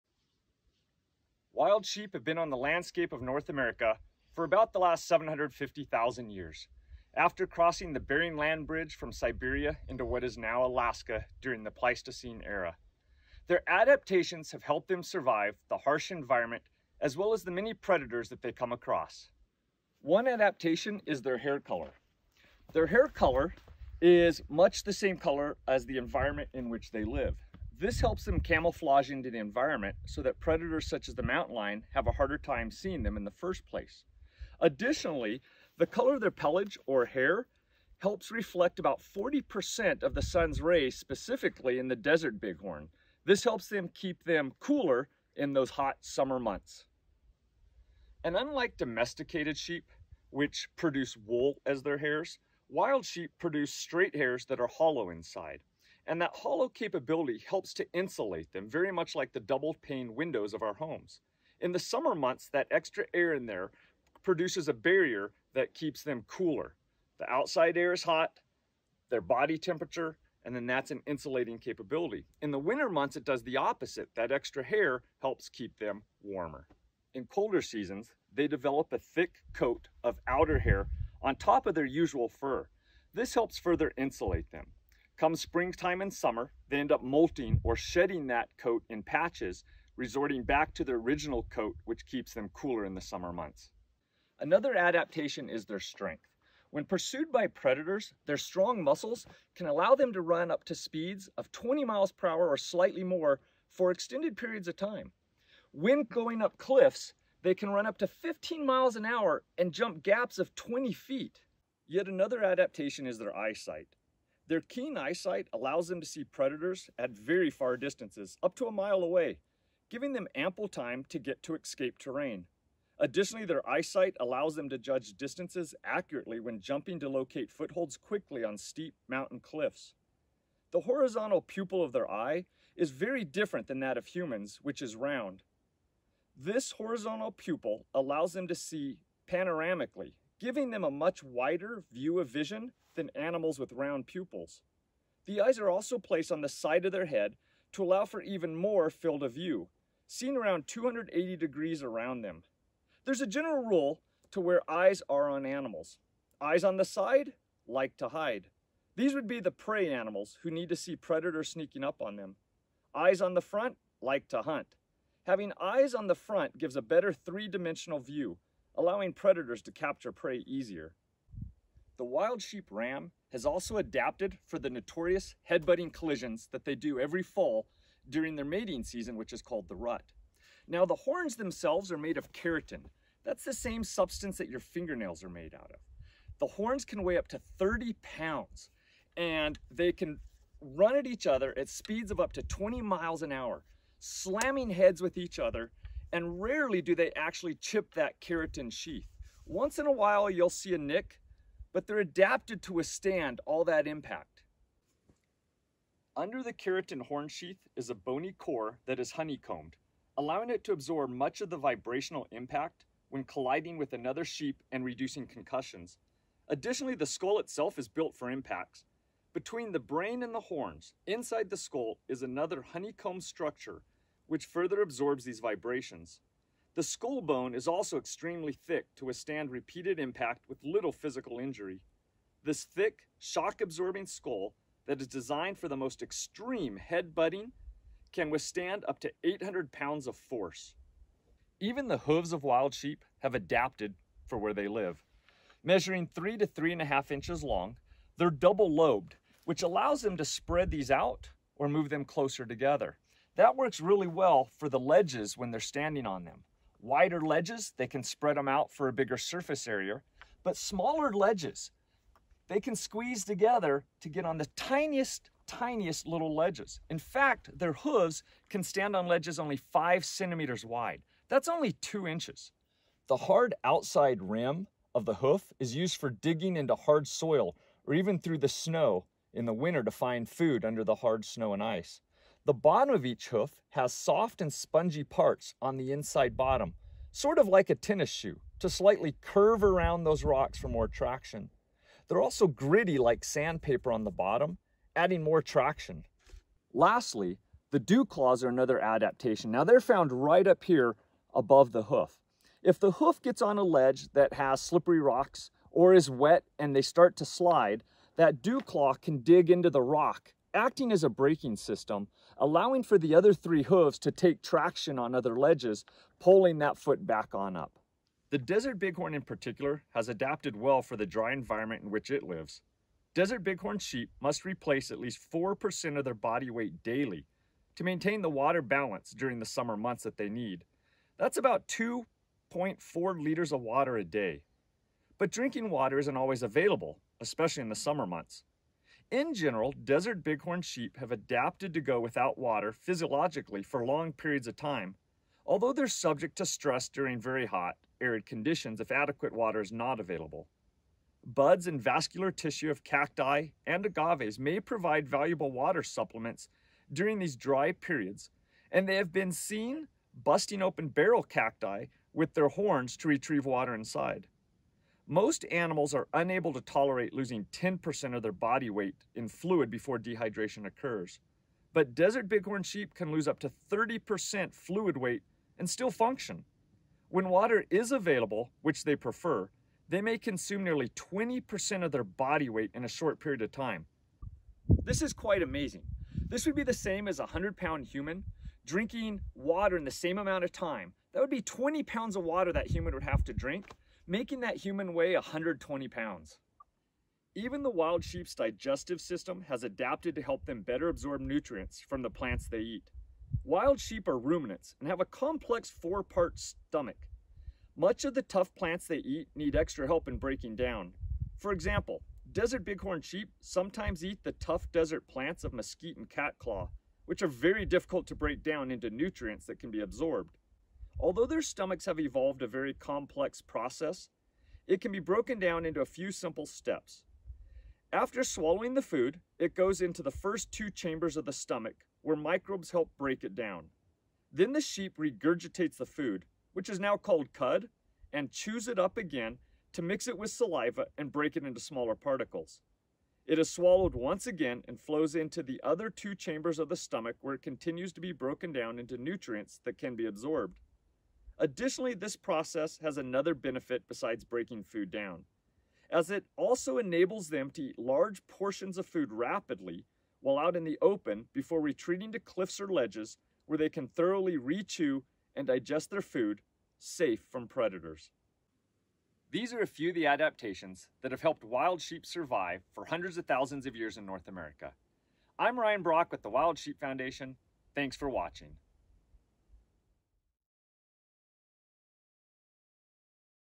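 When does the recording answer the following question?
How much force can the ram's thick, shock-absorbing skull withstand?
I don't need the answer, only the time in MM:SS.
03:59.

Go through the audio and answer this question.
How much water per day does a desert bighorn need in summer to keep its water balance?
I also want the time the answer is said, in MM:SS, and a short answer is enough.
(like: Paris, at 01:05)
2.4 liters, at 05:31.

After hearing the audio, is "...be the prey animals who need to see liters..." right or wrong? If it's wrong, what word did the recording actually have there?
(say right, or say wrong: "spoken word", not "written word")
wrong: "predators", not "liters".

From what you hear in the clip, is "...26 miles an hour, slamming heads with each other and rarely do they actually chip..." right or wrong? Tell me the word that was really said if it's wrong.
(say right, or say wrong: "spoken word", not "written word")
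wrong: "20", not "26".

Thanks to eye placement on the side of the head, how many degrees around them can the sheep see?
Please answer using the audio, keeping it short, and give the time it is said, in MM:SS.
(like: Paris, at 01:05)
280 degrees, at 02:30.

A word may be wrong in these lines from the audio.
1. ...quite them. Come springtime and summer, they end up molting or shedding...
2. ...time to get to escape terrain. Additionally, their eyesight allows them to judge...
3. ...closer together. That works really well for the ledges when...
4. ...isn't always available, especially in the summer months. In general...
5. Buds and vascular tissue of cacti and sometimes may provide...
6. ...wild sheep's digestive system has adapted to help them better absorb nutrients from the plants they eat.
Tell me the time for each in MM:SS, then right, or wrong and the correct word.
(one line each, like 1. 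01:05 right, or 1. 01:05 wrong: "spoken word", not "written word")
1. 01:23 wrong: "insulate", not "quite"
2. 02:00 right
3. 04:12 right
4. 05:35 right
5. 05:51 wrong: "agaves", not "sometimes"
6. 06:37 right.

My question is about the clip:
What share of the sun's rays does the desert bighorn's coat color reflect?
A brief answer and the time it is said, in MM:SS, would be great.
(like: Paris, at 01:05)
40%, at 00:39.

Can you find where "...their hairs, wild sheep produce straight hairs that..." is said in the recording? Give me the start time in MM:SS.
00:51.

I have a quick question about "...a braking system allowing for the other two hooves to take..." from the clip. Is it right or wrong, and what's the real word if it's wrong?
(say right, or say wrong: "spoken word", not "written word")
wrong: "three", not "two".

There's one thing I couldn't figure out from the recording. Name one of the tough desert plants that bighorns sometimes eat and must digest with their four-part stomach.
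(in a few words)
mesquite.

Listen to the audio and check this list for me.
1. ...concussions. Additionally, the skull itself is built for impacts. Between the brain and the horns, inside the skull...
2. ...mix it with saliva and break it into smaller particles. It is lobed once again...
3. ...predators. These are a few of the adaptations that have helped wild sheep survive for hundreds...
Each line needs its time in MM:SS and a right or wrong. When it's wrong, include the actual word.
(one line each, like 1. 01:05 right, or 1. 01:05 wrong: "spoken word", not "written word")
1. 03:35 right
2. 07:19 wrong: "swallowed", not "lobed"
3. 07:47 right.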